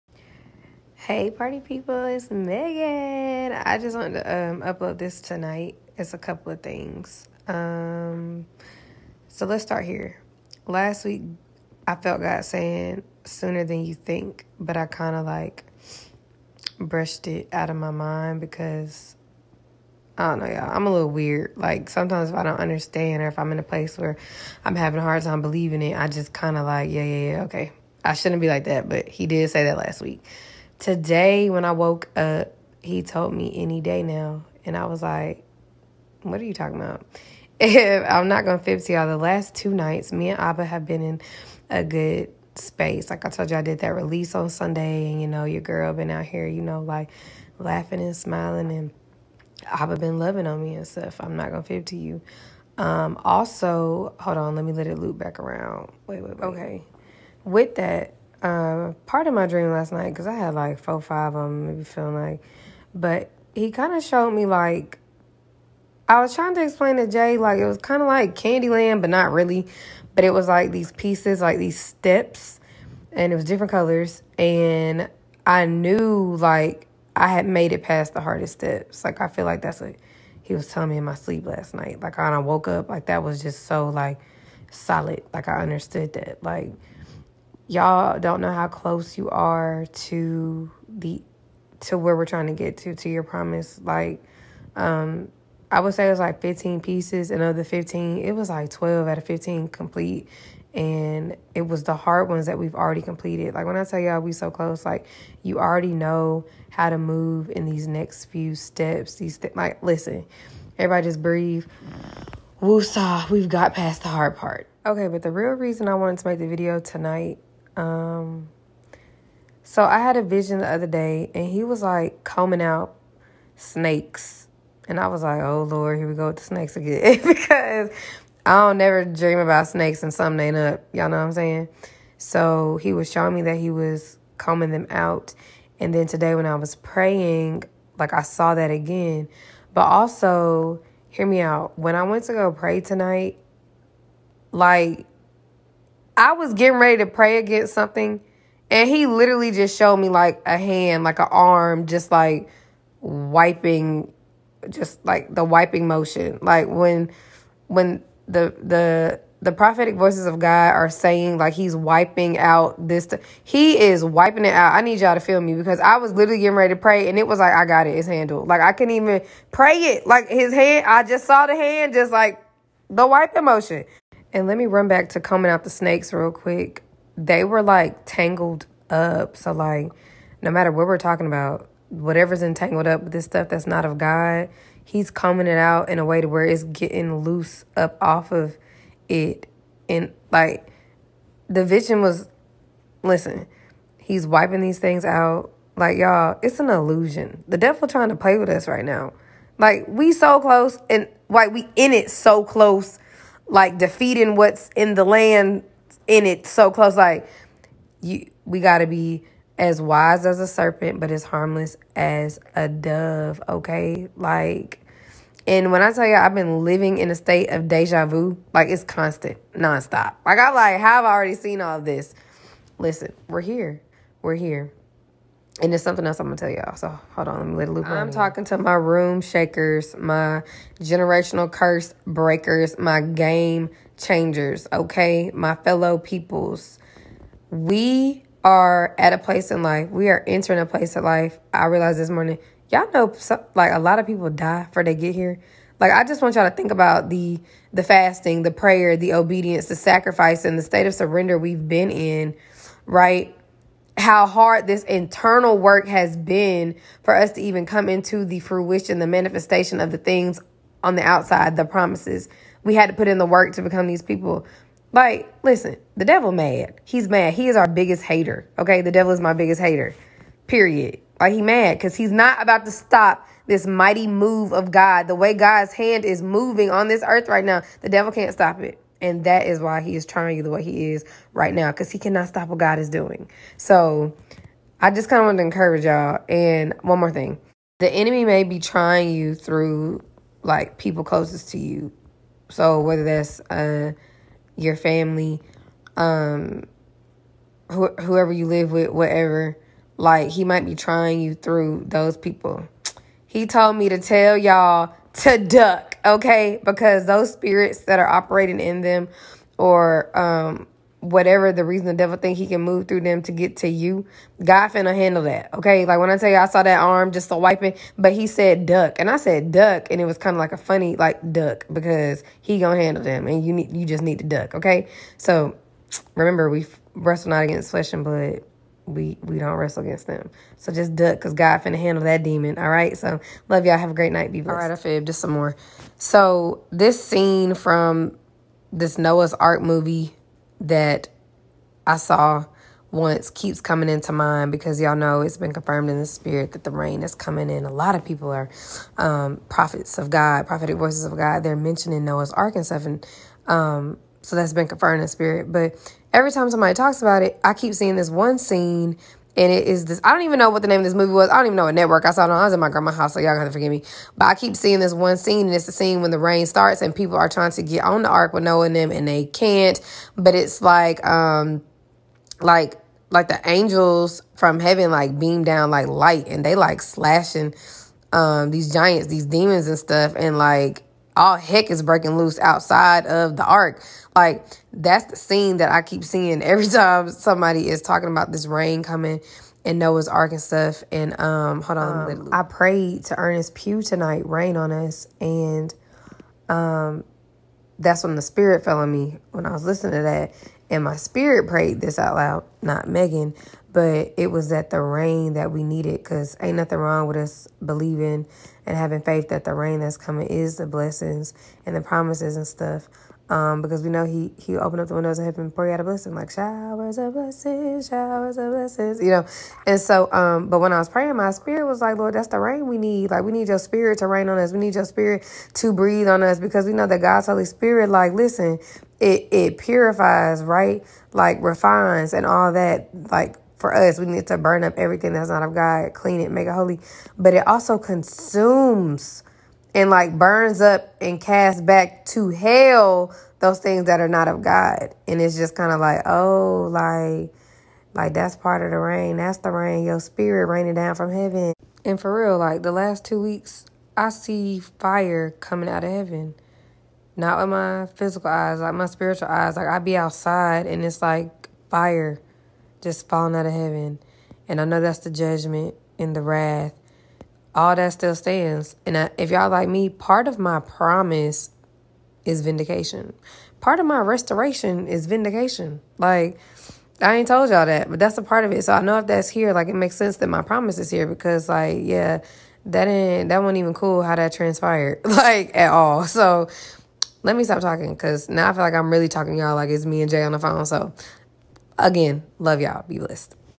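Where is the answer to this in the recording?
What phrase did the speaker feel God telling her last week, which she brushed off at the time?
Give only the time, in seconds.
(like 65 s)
13 s.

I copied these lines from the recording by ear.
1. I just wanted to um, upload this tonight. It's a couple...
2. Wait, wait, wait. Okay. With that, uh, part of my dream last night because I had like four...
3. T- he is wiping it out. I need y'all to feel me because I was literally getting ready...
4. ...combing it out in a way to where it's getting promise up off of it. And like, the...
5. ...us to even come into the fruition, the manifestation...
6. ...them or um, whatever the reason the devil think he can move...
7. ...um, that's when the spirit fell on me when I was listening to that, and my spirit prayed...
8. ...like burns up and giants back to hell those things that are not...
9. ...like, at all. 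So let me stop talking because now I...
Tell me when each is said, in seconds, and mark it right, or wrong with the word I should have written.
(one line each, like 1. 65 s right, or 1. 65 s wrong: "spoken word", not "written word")
1. 3 s right
2. 56 s right
3. 163 s right
4. 185 s wrong: "loose", not "promise"
5. 257 s right
6. 308 s right
7. 396 s right
8. 439 s wrong: "casts", not "giants"
9. 485 s right.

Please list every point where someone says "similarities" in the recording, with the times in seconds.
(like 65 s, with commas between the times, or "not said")
not said.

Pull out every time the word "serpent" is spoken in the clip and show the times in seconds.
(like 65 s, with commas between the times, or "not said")
210 s.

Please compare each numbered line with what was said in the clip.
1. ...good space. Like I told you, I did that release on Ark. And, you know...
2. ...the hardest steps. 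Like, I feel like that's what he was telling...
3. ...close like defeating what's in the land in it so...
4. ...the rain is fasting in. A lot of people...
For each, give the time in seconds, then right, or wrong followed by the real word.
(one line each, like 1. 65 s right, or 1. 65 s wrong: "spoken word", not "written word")
1. 41 s wrong: "Sunday", not "Ark"
2. 78 s right
3. 202 s right
4. 346 s wrong: "coming", not "fasting".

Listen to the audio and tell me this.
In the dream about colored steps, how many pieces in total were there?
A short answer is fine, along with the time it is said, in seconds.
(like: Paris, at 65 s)
15, at 96 s.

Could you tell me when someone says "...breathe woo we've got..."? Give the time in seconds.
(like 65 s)
111 s.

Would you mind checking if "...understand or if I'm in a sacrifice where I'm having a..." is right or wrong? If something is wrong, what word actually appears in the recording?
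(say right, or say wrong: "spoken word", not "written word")
wrong: "place", not "sacrifice".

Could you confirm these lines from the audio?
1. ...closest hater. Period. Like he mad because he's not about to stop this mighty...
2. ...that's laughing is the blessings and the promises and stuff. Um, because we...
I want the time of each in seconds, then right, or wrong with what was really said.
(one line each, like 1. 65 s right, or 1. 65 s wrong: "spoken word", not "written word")
1. 269 s wrong: "biggest", not "closest"
2. 409 s wrong: "coming", not "laughing".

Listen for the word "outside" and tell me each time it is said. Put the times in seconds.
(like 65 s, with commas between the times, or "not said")
261 s, 382 s, 459 s.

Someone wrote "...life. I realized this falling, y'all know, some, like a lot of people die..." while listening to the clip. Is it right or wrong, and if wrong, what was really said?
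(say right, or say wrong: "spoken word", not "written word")
wrong: "morning", not "falling".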